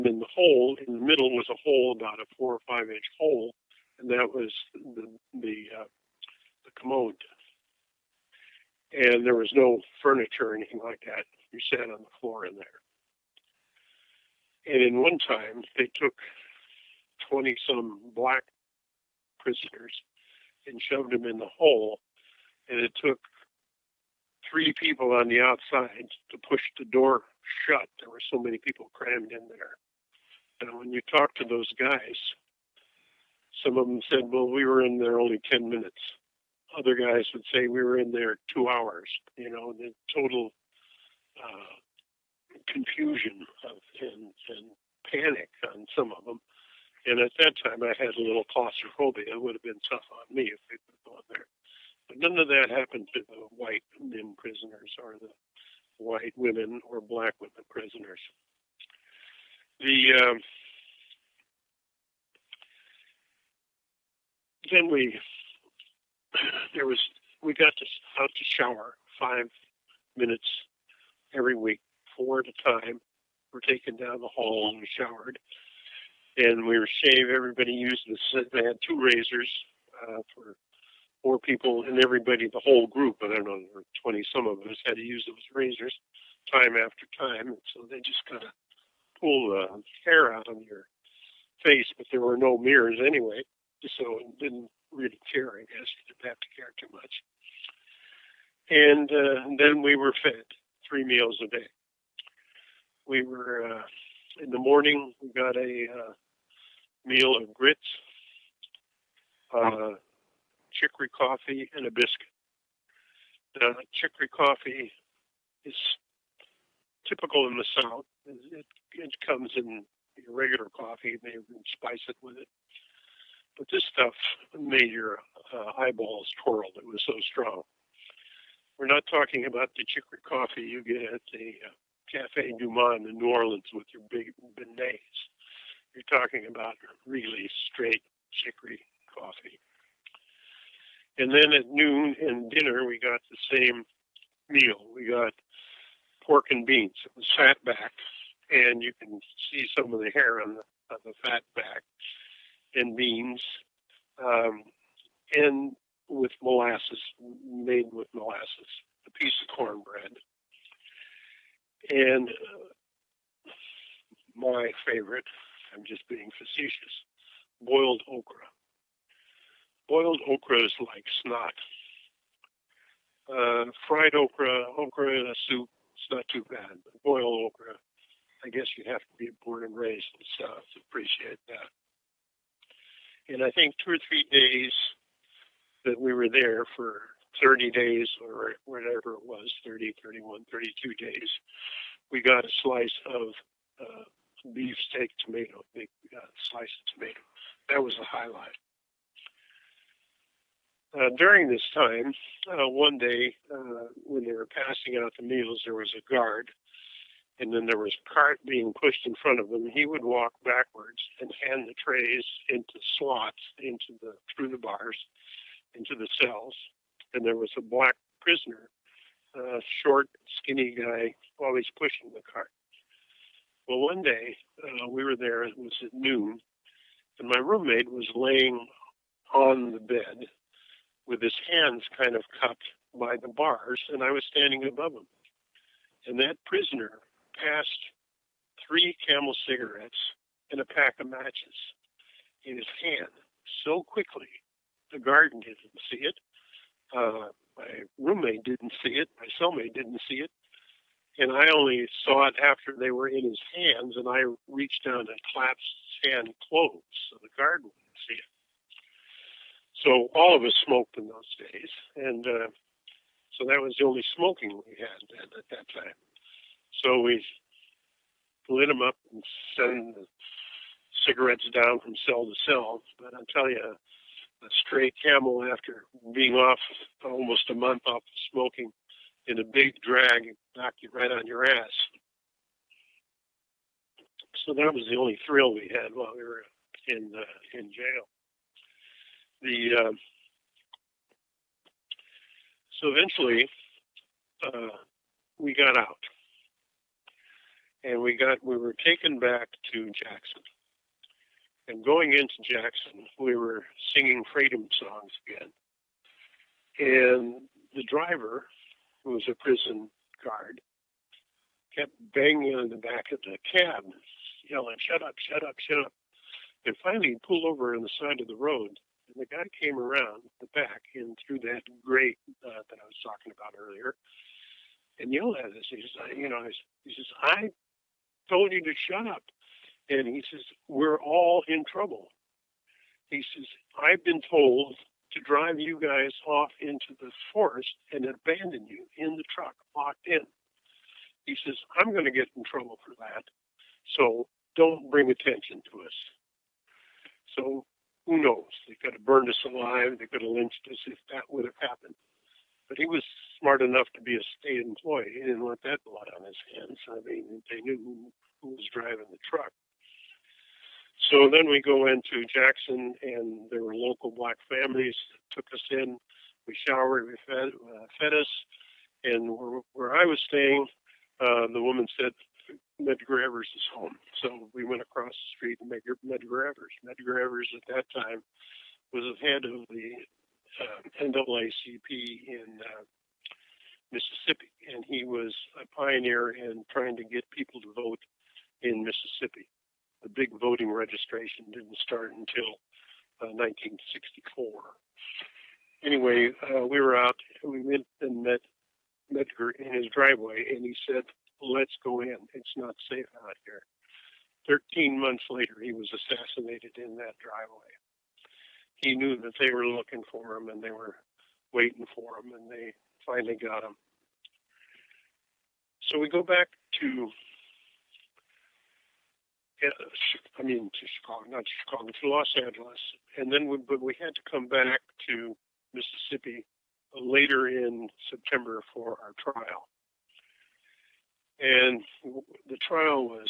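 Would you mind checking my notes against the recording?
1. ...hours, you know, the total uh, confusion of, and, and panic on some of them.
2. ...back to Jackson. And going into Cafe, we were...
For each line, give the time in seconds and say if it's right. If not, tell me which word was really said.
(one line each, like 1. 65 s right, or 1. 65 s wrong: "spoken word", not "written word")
1. 38 s right
2. 299 s wrong: "Jackson", not "Cafe".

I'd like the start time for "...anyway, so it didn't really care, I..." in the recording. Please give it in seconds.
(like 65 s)
92 s.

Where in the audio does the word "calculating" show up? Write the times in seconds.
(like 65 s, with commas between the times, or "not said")
not said.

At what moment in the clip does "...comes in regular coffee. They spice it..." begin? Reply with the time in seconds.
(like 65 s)
119 s.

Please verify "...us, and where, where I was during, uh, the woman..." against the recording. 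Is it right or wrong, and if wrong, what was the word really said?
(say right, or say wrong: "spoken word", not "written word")
wrong: "staying", not "during".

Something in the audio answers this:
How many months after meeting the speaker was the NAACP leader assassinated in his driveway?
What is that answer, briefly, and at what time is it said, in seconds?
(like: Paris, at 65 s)
13, at 404 s.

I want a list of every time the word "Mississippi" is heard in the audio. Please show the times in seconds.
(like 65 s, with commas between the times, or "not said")
383 s, 388 s, 425 s.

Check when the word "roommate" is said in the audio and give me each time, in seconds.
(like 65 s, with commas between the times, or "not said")
227 s, 247 s.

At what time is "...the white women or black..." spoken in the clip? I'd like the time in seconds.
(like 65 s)
55 s.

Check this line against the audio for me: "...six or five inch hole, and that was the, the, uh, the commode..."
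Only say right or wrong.
wrong.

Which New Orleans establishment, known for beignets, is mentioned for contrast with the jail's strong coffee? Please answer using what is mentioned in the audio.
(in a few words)
Cafe Du Monde.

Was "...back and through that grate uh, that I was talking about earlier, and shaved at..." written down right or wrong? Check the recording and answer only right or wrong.
wrong.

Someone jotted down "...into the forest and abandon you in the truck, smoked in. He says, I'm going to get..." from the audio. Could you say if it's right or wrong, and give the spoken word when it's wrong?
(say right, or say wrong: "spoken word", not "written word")
wrong: "locked", not "smoked".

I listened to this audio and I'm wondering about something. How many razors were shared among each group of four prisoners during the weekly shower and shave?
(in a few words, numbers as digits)
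2.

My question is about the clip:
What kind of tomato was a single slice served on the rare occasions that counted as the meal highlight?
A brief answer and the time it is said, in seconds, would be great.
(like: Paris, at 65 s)
beefsteak, at 194 s.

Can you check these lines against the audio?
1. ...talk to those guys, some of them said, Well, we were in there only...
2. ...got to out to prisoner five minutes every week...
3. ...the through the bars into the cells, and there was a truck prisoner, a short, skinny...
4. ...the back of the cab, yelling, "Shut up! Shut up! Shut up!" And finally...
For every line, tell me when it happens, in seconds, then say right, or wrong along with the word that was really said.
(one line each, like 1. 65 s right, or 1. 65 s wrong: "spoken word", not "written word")
1. 31 s right
2. 67 s wrong: "shower", not "prisoner"
3. 214 s wrong: "black", not "truck"
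4. 312 s right.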